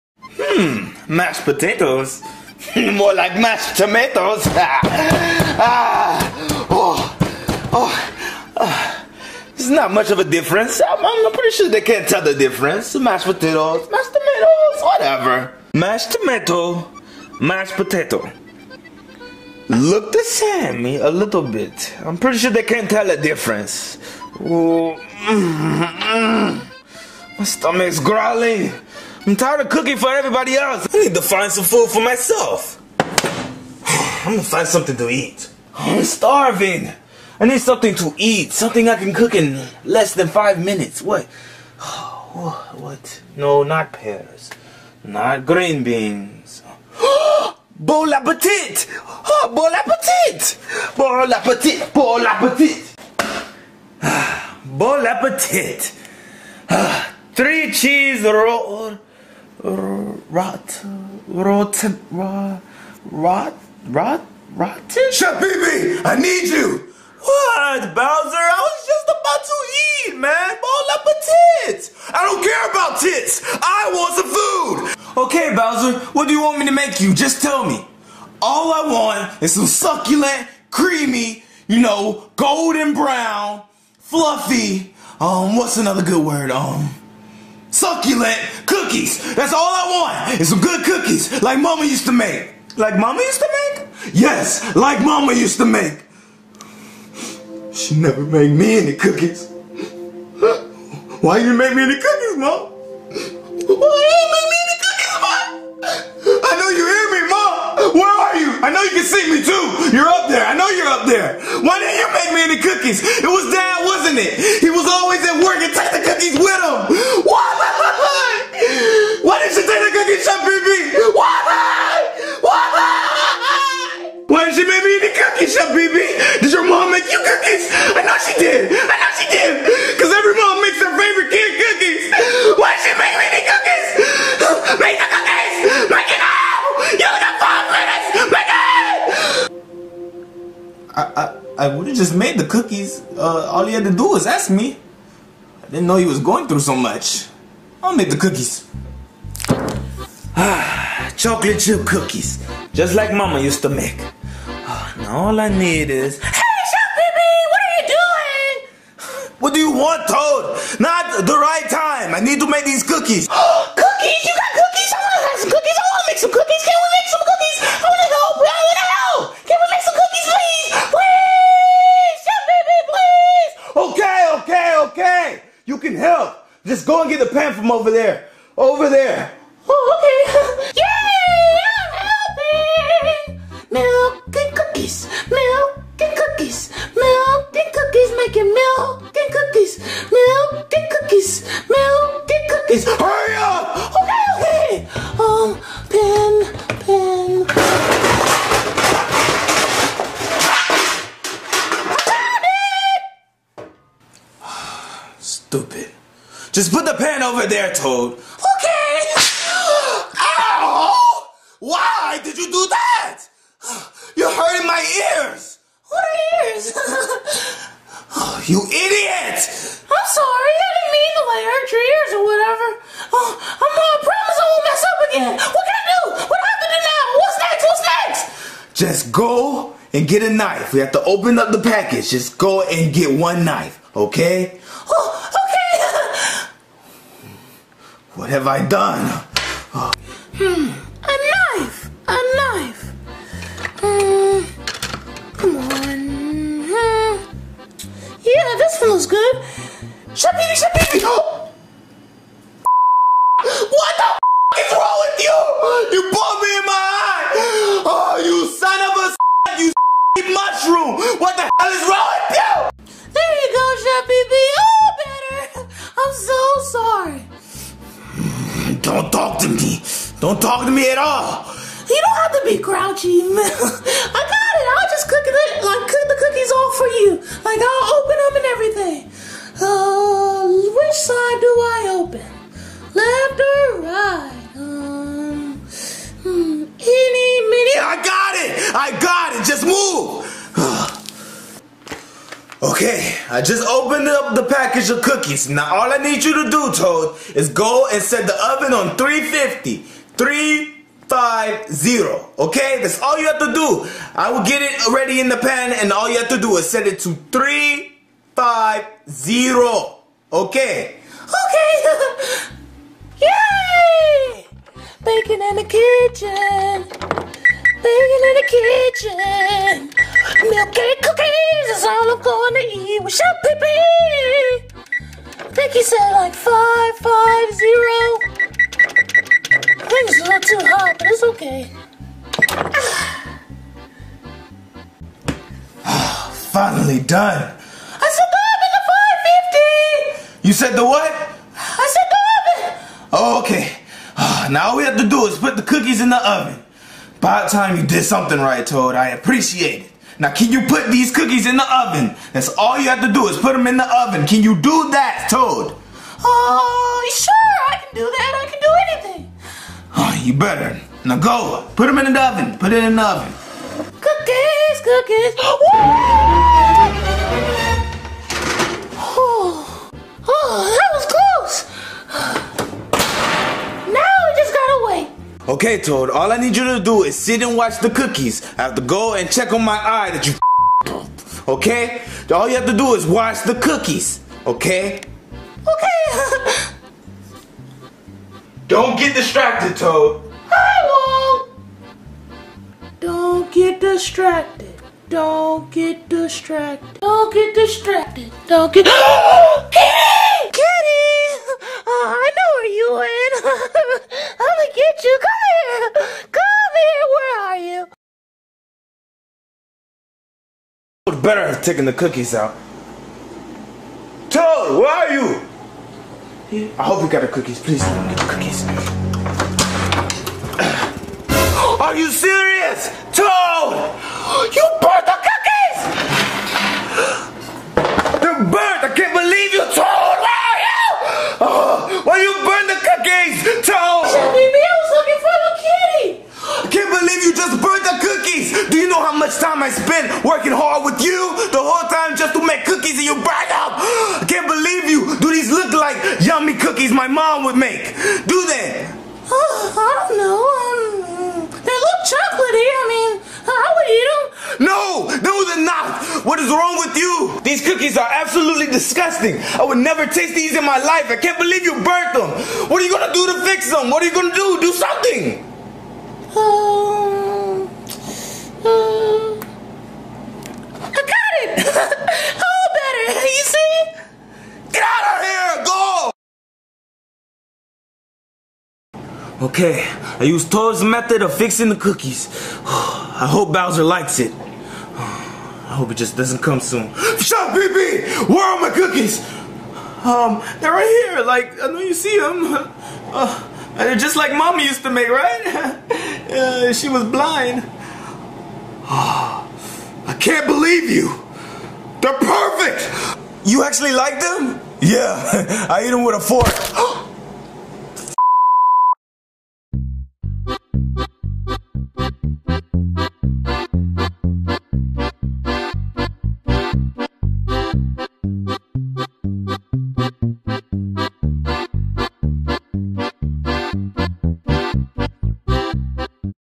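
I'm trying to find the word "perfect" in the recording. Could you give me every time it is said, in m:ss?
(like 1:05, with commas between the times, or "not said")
8:22.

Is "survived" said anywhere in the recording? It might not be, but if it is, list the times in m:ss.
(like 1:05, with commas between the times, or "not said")
5:38.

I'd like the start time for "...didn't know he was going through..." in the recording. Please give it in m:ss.
2:25.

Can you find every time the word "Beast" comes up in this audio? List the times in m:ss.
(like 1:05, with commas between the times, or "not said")
not said.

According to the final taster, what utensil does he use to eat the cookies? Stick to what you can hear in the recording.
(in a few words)
fork.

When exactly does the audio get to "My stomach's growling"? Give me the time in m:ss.
0:27.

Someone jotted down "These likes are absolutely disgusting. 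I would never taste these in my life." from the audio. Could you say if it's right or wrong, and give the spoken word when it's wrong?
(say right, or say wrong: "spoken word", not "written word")
wrong: "cookies", not "likes".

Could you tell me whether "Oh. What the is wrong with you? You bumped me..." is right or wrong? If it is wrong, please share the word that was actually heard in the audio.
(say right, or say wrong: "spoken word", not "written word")
right.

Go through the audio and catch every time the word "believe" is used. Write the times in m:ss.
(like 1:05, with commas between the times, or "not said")
7:09, 7:24, 7:41, 8:20.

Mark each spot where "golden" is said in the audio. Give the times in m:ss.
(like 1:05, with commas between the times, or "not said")
1:22.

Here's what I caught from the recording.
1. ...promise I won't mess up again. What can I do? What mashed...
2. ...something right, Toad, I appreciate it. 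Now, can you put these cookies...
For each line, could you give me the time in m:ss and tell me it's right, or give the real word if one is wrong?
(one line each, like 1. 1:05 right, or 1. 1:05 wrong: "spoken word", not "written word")
1. 3:44 wrong: "happened", not "mashed"
2. 5:48 right.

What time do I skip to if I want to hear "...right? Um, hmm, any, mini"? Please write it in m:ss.
4:43.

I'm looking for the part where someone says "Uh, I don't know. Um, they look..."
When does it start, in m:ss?
7:29.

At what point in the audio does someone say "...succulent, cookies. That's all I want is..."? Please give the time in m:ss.
1:27.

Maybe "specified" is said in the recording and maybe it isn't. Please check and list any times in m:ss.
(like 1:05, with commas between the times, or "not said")
not said.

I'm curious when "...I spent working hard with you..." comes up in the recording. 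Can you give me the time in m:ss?
7:19.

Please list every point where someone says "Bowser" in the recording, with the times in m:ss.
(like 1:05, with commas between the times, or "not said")
1:07, 1:15, 8:03.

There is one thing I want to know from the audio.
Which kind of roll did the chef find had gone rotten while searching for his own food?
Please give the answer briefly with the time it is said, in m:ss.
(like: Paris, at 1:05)
three cheese roll, at 0:57.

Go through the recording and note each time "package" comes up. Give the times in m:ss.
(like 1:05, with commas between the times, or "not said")
3:51, 4:54.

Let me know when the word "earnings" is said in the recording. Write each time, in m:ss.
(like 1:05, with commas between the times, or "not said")
not said.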